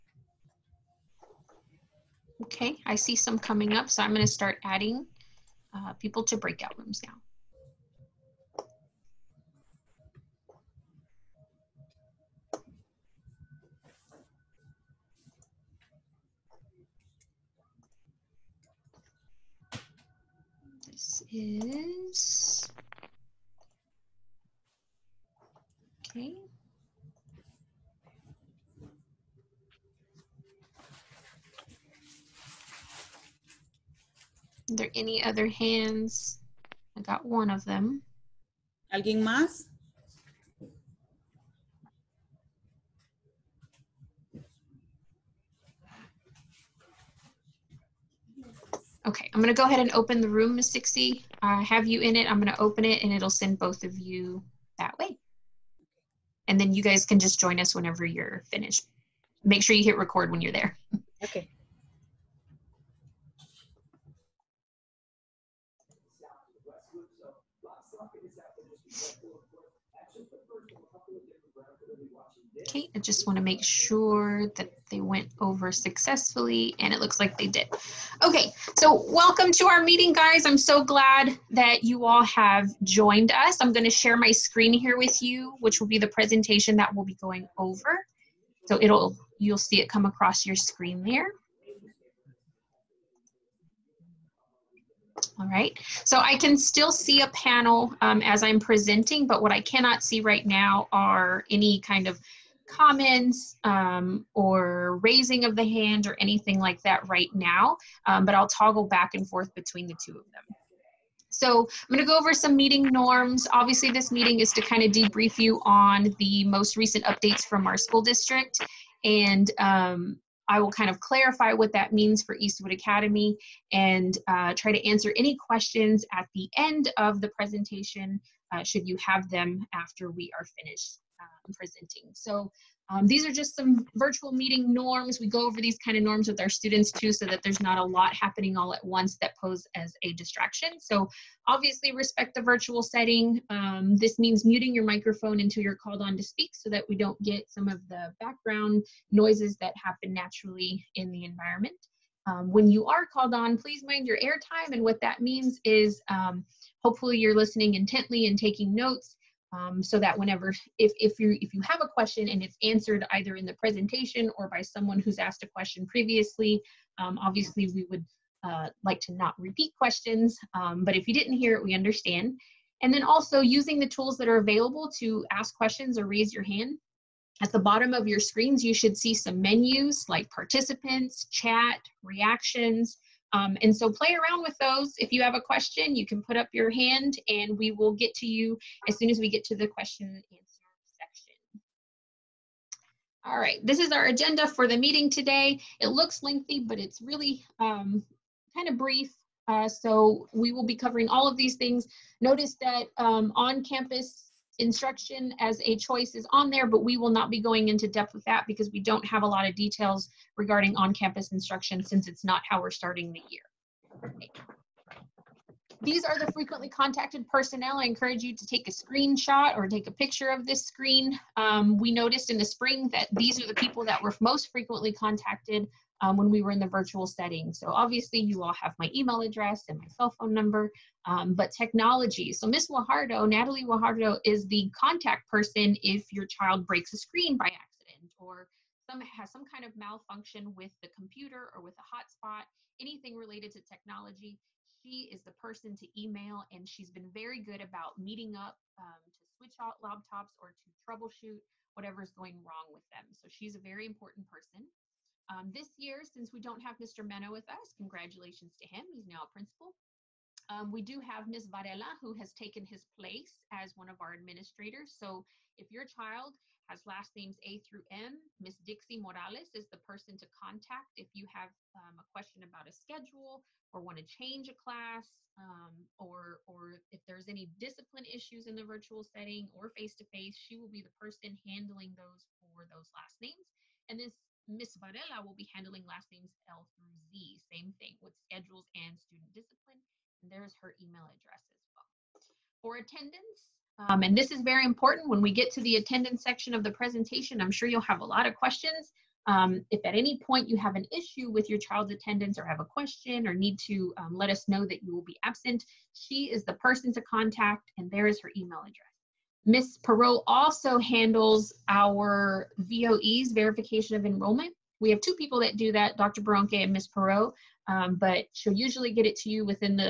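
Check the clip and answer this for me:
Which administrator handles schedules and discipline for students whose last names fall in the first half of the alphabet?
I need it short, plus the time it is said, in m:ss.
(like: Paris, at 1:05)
Dixie Morales, at 4:28.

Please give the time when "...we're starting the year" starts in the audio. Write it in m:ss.
3:32.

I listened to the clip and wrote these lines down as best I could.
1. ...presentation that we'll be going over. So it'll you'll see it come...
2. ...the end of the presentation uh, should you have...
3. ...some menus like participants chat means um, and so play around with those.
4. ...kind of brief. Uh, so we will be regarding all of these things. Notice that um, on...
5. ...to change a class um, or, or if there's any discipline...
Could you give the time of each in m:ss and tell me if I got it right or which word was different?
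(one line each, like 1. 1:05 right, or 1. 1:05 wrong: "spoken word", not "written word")
1. 1:26 right
2. 2:06 right
3. 2:59 wrong: "reactions", not "means"
4. 3:18 wrong: "covering", not "regarding"
5. 4:33 right.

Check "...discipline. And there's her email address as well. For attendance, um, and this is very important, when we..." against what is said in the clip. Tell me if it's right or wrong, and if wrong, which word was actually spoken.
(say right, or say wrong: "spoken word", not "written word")
right.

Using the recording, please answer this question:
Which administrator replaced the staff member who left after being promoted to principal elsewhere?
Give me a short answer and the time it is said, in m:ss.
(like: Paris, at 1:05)
Ms. Varela, at 4:21.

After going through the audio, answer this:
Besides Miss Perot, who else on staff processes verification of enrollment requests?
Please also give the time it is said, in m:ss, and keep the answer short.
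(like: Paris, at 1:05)
Dr. Baronke, at 5:15.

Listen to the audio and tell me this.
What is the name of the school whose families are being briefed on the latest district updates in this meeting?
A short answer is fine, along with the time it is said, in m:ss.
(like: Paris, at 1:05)
Eastwood Academy, at 2:02.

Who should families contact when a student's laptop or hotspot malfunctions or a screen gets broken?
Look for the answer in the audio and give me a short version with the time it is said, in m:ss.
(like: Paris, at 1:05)
Natalie Guajardo, at 3:53.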